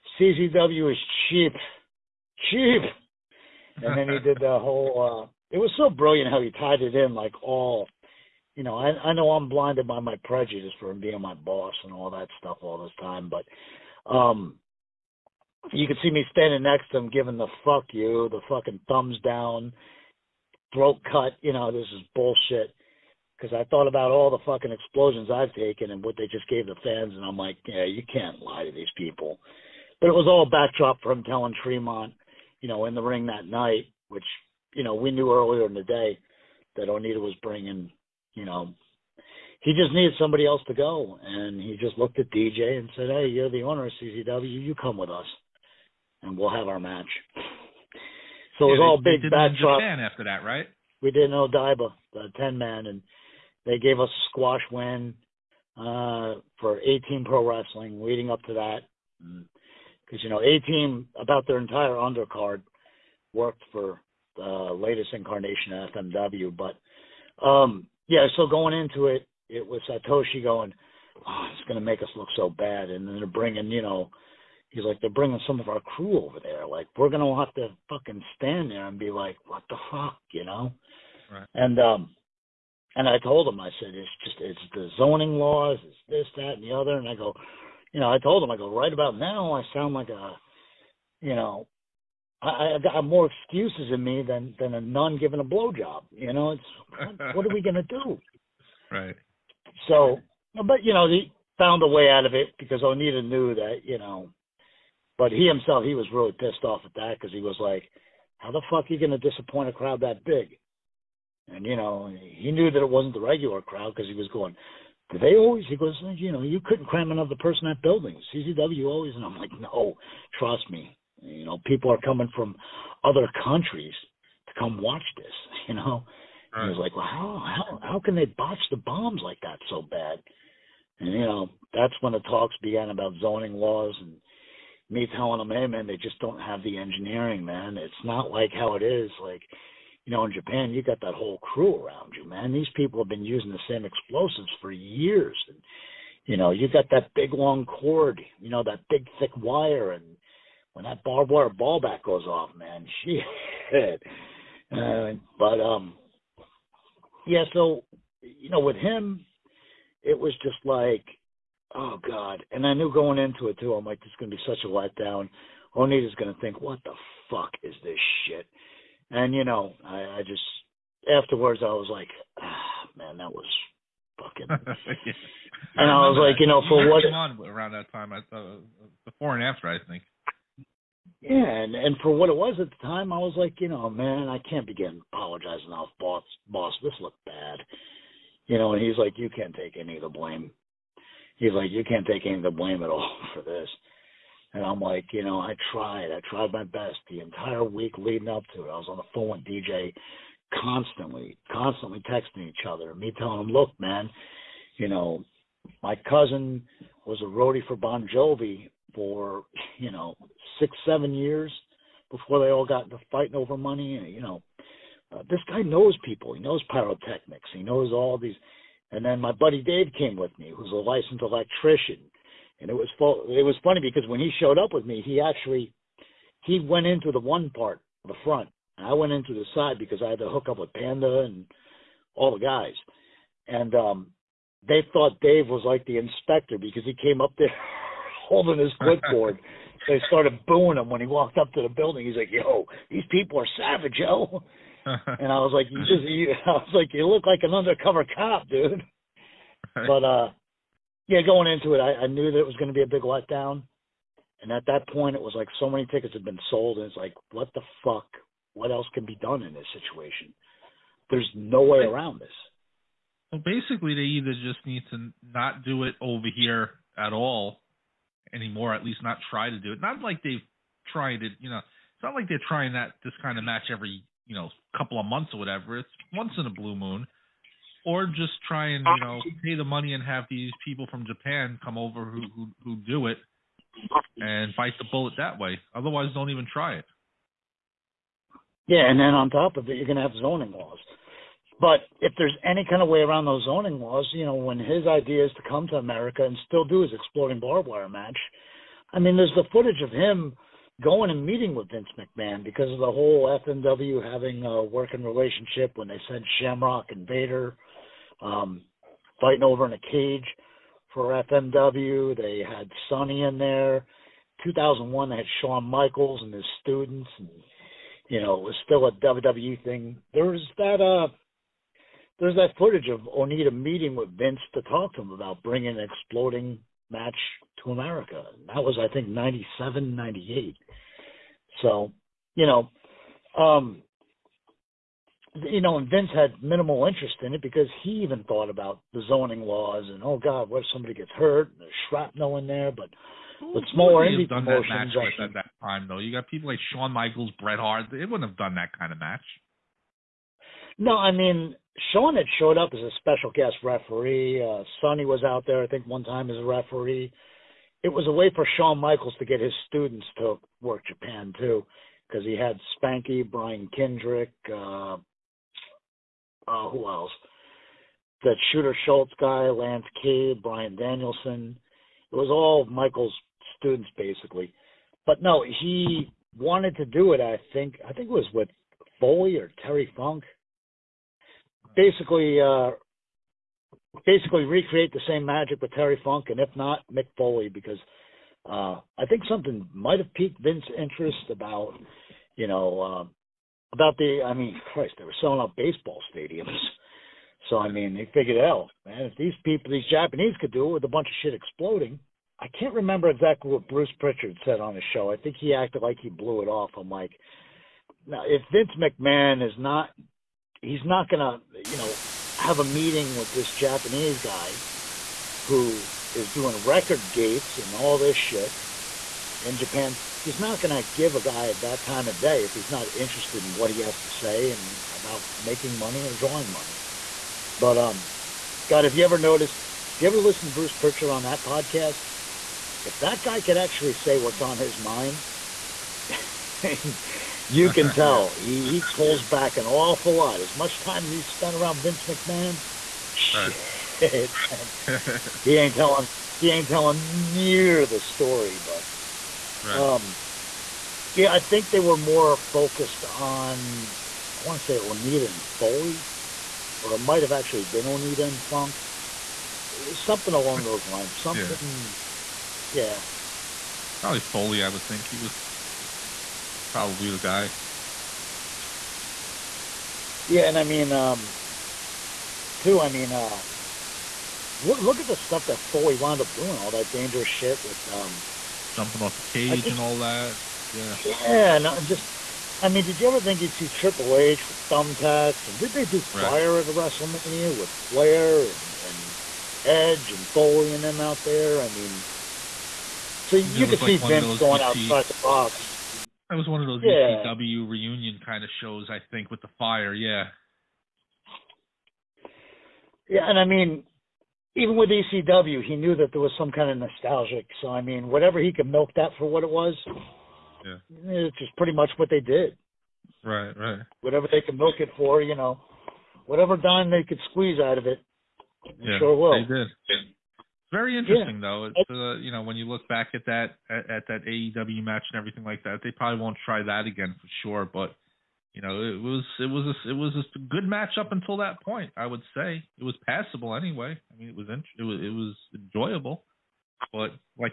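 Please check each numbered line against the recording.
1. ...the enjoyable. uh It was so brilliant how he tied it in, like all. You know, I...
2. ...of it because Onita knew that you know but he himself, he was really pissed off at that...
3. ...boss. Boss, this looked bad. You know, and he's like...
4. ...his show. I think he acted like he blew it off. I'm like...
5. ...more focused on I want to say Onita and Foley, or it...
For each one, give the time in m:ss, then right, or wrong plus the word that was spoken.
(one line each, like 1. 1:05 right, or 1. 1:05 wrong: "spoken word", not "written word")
1. 0:04 wrong: "whole", not "enjoyable"
2. 1:42 right
3. 3:05 right
4. 6:44 right
5. 7:31 right.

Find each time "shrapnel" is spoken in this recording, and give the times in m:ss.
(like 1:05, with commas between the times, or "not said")
5:41.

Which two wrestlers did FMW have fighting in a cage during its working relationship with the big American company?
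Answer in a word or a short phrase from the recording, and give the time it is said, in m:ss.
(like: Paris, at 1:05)
Shamrock and Vader, at 5:06.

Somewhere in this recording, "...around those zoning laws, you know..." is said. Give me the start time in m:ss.
4:52.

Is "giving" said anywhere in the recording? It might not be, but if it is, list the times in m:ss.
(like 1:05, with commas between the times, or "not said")
0:17, 1:35.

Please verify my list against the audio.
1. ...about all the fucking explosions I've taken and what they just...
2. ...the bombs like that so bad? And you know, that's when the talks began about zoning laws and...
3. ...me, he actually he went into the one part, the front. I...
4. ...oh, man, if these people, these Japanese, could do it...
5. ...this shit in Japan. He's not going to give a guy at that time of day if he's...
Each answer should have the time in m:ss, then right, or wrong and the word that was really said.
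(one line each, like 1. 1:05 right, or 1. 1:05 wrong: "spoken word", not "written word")
1. 0:23 right
2. 2:08 right
3. 3:44 right
4. 6:38 right
5. 6:57 right.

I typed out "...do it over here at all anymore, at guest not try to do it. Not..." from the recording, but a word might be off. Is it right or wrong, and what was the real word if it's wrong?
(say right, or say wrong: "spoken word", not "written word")
wrong: "least", not "guest".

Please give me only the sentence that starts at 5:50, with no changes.
No, I mean Shawn had showed up as a special guest referee.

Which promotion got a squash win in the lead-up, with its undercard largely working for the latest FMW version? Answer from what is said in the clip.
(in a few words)
A Team Pro Wrestling.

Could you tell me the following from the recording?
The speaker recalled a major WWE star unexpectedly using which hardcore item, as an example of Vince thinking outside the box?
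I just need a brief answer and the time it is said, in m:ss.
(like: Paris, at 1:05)
thumbtacks, at 8:04.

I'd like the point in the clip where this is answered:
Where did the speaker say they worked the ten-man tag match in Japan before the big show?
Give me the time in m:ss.
0:51.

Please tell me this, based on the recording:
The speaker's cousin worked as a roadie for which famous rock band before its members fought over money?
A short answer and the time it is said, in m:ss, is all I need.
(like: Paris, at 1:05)
Bon Jovi, at 3:27.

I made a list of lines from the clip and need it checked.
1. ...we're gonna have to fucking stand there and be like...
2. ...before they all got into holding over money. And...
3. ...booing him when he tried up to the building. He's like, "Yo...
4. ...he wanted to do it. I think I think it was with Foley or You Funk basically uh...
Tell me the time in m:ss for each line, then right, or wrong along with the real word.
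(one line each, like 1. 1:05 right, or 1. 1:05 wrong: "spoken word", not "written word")
1. 1:16 right
2. 3:32 wrong: "fighting", not "holding"
3. 4:00 wrong: "walked", not "tried"
4. 6:15 wrong: "Terry", not "You".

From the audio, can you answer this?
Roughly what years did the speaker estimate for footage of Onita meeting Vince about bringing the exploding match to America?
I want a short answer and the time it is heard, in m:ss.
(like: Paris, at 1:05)
97, 98, at 5:29.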